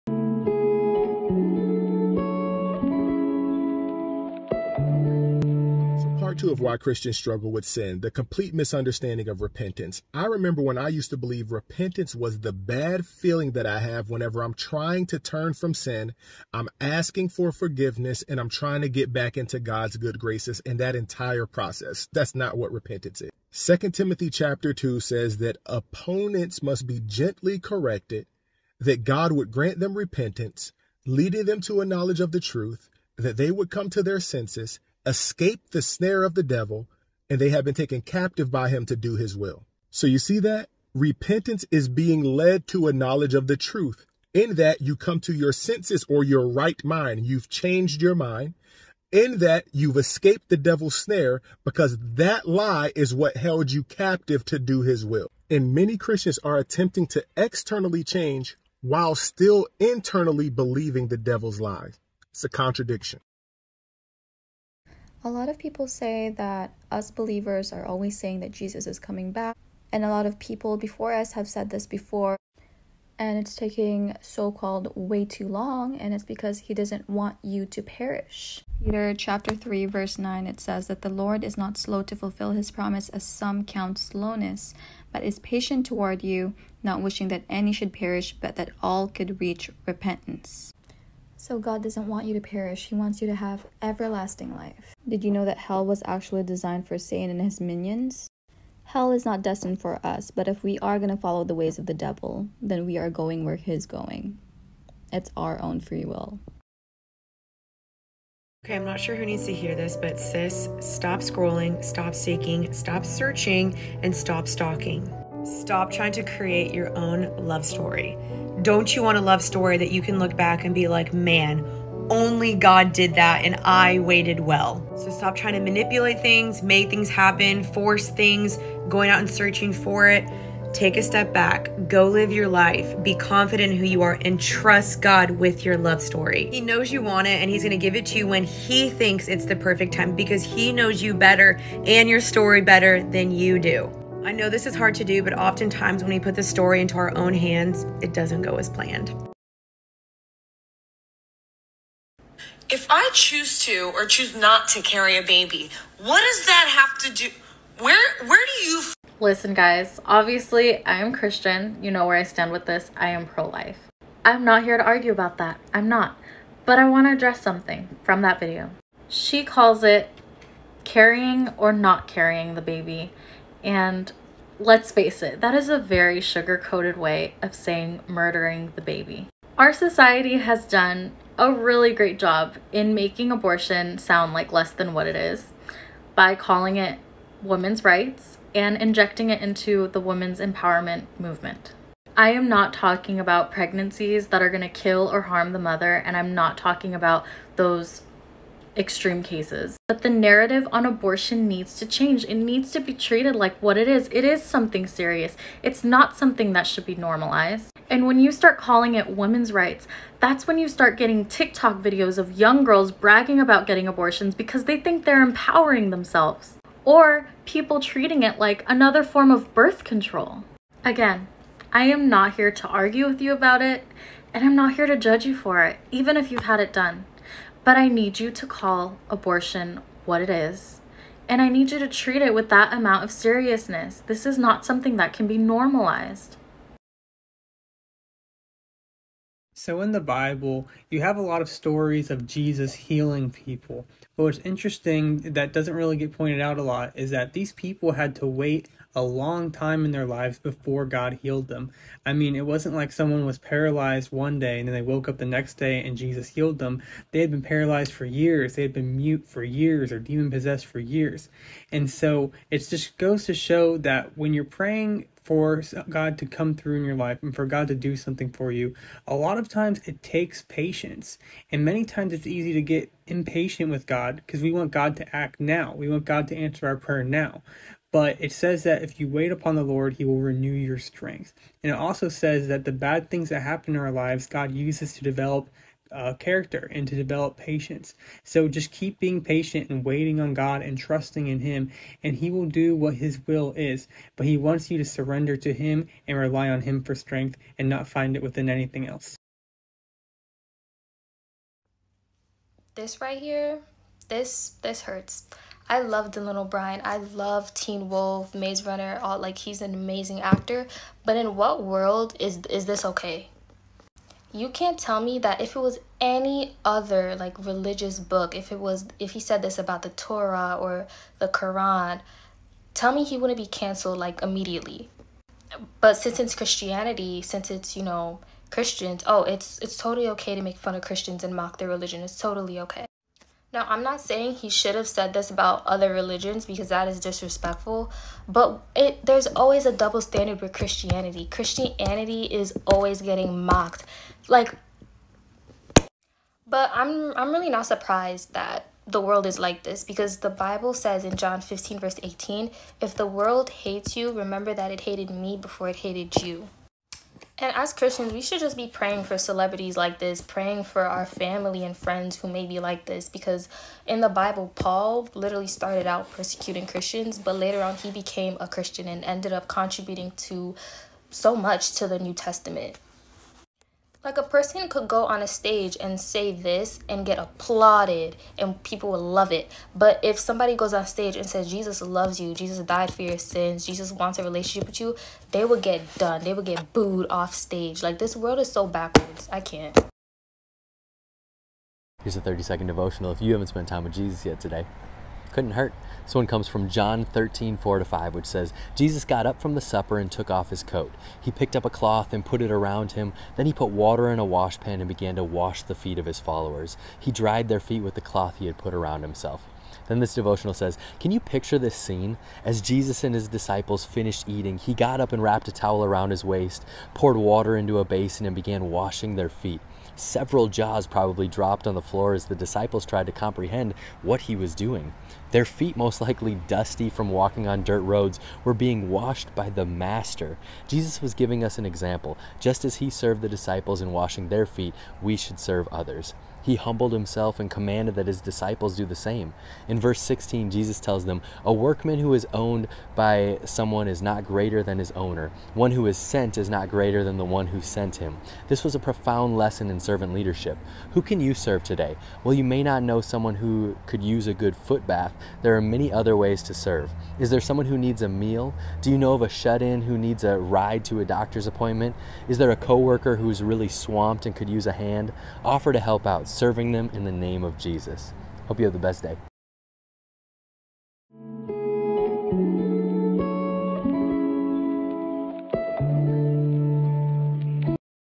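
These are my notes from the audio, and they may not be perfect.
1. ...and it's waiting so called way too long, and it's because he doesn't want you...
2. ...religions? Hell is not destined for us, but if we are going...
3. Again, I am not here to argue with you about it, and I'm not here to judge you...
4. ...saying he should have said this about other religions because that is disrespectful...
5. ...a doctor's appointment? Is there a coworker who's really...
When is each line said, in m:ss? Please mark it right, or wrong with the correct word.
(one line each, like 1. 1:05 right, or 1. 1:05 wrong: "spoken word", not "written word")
1. 1:13 wrong: "taking", not "waiting"
2. 1:37 wrong: "minions", not "religions"
3. 3:40 right
4. 5:33 right
5. 7:40 right.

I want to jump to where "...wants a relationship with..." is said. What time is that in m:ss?
6:23.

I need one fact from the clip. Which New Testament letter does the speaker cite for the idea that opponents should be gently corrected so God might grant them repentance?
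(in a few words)
Second Timothy.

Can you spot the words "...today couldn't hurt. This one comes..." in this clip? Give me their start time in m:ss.
6:34.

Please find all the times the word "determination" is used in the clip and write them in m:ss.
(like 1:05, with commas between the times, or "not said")
not said.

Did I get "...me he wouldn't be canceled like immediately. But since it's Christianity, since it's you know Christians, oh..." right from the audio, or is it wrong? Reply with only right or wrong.
right.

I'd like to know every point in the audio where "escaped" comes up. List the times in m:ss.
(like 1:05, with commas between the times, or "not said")
0:35, 0:49.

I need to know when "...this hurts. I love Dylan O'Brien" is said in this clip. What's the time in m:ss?
5:04.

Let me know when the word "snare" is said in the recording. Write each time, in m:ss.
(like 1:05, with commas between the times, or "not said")
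0:35, 0:50.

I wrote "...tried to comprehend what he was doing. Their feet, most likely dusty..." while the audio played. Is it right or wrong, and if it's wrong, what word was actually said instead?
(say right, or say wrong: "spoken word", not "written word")
right.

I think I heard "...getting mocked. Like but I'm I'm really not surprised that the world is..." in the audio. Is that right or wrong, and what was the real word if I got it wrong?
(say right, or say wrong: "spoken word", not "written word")
right.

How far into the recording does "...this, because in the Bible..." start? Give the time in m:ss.
6:02.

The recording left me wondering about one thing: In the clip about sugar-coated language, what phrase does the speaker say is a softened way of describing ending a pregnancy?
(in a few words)
carrying or not carrying the baby.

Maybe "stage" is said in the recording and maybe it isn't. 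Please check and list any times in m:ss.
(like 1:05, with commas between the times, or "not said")
6:15, 6:20, 6:27.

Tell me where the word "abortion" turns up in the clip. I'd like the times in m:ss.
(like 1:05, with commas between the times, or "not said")
3:03, 3:20, 3:33, 3:49.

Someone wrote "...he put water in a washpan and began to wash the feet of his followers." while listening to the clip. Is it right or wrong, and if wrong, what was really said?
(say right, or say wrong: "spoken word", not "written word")
right.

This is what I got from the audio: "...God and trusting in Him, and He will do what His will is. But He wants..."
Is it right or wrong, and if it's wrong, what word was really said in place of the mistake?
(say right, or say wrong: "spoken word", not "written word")
right.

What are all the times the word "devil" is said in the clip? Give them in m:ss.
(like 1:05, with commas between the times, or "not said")
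0:36, 0:50, 1:01, 1:41.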